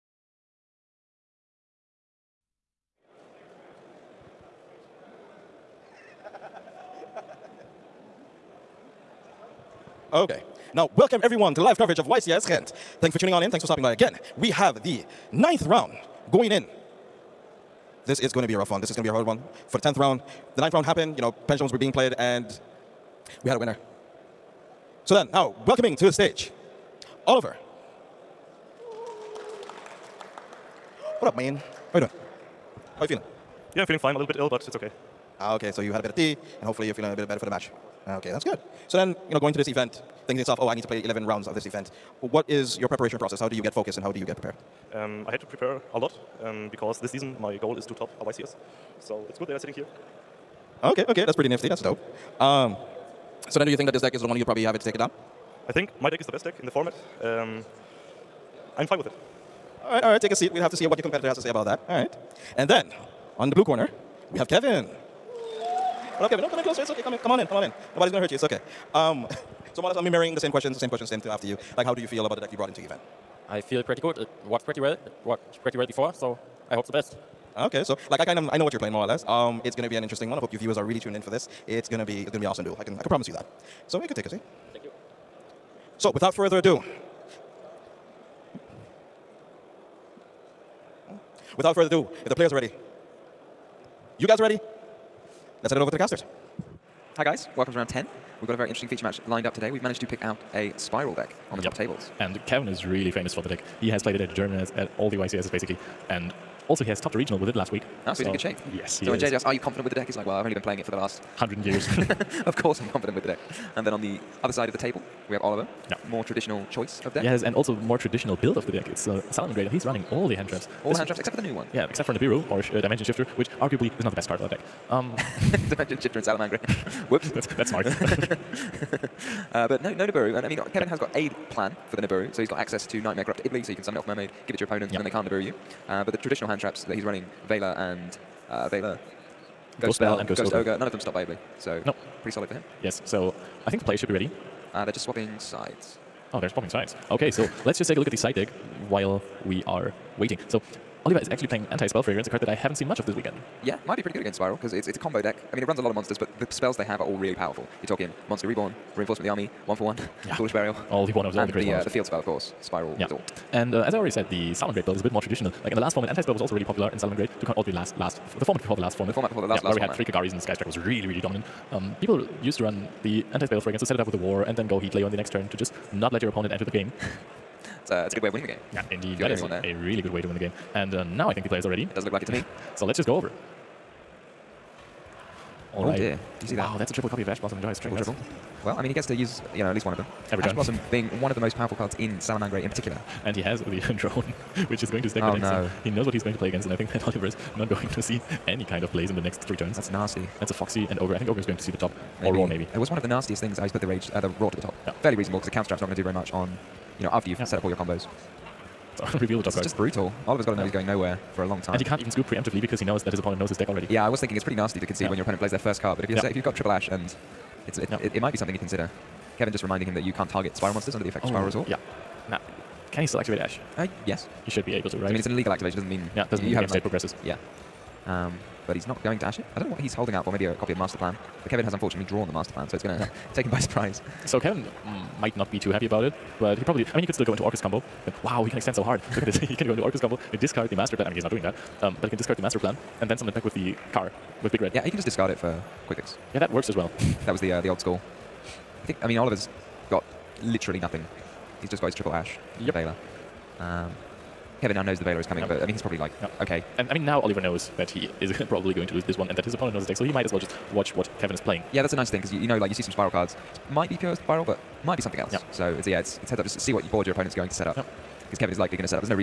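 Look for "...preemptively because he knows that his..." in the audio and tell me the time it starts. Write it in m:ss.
3:32.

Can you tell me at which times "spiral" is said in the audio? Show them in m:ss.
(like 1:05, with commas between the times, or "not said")
2:42.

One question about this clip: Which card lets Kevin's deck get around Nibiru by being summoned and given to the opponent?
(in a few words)
Knightmare Corruptor Iblee.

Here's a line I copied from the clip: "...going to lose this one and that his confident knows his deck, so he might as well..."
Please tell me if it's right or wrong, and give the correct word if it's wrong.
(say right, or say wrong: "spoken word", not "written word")
wrong: "opponent", not "confident".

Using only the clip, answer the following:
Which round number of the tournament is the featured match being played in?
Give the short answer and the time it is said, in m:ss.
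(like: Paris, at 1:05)
10, at 1:37.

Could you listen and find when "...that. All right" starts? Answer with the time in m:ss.
1:01.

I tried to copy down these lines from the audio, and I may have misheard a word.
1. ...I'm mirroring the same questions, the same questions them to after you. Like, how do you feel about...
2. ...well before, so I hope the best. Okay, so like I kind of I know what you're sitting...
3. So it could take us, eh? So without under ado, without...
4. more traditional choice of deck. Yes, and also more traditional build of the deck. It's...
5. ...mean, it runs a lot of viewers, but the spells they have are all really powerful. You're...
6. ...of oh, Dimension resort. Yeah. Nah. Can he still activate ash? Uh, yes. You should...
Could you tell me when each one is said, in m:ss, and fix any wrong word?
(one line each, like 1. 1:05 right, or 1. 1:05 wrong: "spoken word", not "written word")
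1. 1:09 right
2. 1:15 wrong: "playing", not "sitting"
3. 1:23 wrong: "further", not "under"
4. 1:56 right
5. 2:35 wrong: "monsters", not "viewers"
6. 3:41 wrong: "SPYRAL", not "Dimension".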